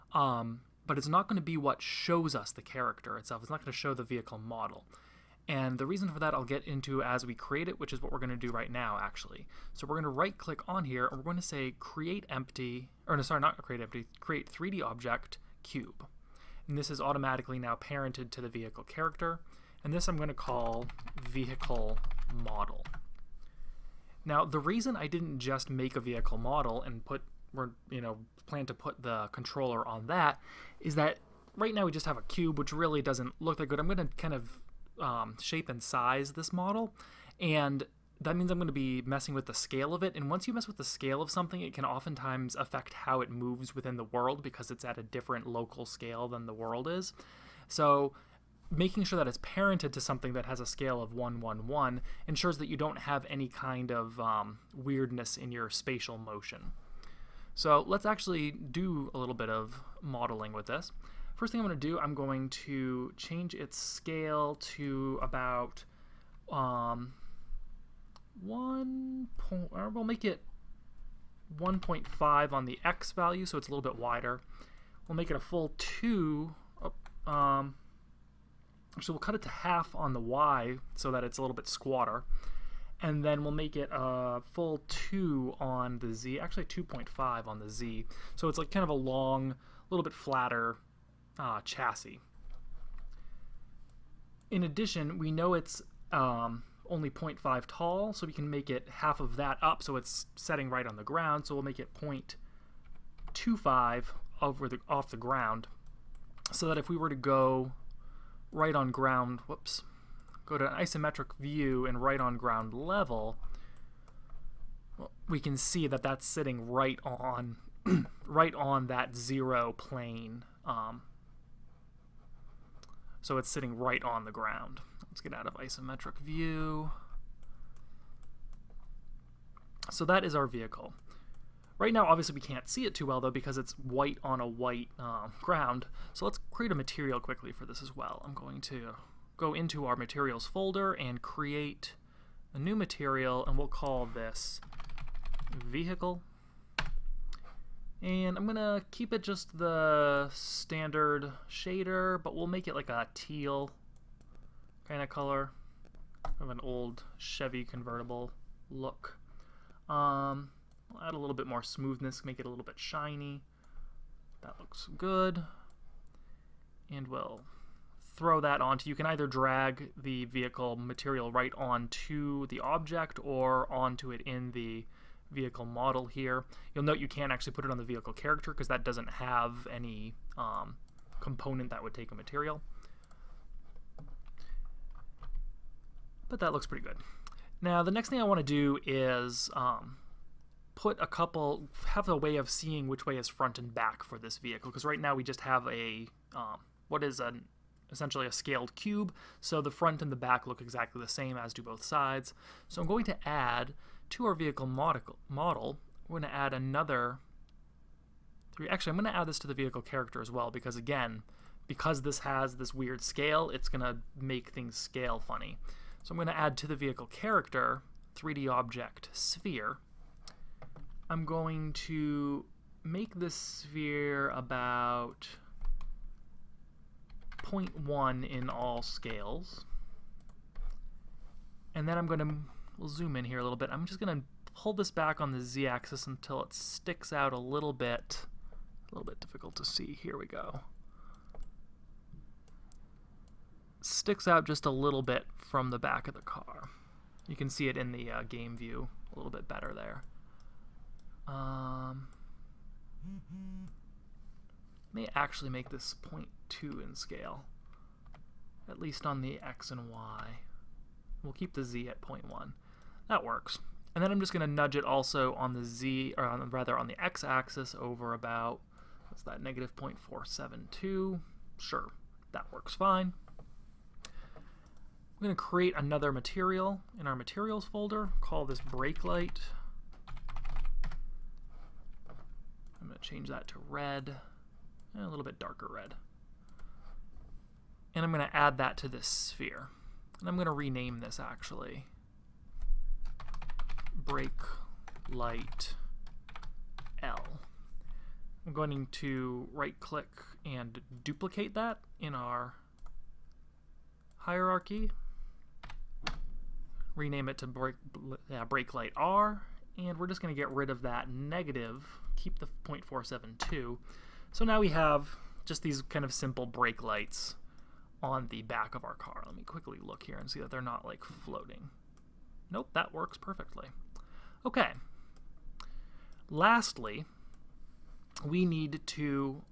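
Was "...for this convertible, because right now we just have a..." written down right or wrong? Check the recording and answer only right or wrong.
wrong.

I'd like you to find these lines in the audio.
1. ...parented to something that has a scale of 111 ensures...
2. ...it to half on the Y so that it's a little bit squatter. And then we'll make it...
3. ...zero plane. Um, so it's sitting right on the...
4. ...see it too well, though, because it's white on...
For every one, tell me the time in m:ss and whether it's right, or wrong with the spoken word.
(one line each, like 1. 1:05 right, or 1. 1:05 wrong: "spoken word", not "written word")
1. 0:49 right
2. 1:19 right
3. 1:59 right
4. 2:12 right.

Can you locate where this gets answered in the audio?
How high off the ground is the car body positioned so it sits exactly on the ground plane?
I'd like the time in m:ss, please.
1:41.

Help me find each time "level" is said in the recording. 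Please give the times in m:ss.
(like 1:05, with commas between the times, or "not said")
1:52.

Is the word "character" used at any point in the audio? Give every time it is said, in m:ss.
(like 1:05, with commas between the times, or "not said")
0:02, 0:18, 2:58, 3:29, 3:37.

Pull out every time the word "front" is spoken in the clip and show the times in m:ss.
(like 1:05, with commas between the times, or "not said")
3:13, 3:19.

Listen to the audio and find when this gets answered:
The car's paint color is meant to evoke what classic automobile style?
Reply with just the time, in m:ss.
2:36.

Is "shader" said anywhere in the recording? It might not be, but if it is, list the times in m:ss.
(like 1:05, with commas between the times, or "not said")
2:31.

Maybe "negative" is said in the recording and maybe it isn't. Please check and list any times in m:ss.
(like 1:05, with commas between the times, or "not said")
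4:29, 5:11.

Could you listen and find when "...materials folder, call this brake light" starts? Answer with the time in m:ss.
4:37.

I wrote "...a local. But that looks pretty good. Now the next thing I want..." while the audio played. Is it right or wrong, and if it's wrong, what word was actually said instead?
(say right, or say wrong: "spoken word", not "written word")
wrong: "material", not "local".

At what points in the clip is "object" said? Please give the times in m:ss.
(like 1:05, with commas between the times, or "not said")
0:14, 2:52, 3:38.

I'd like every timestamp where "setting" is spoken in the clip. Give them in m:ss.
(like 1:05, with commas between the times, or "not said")
1:40.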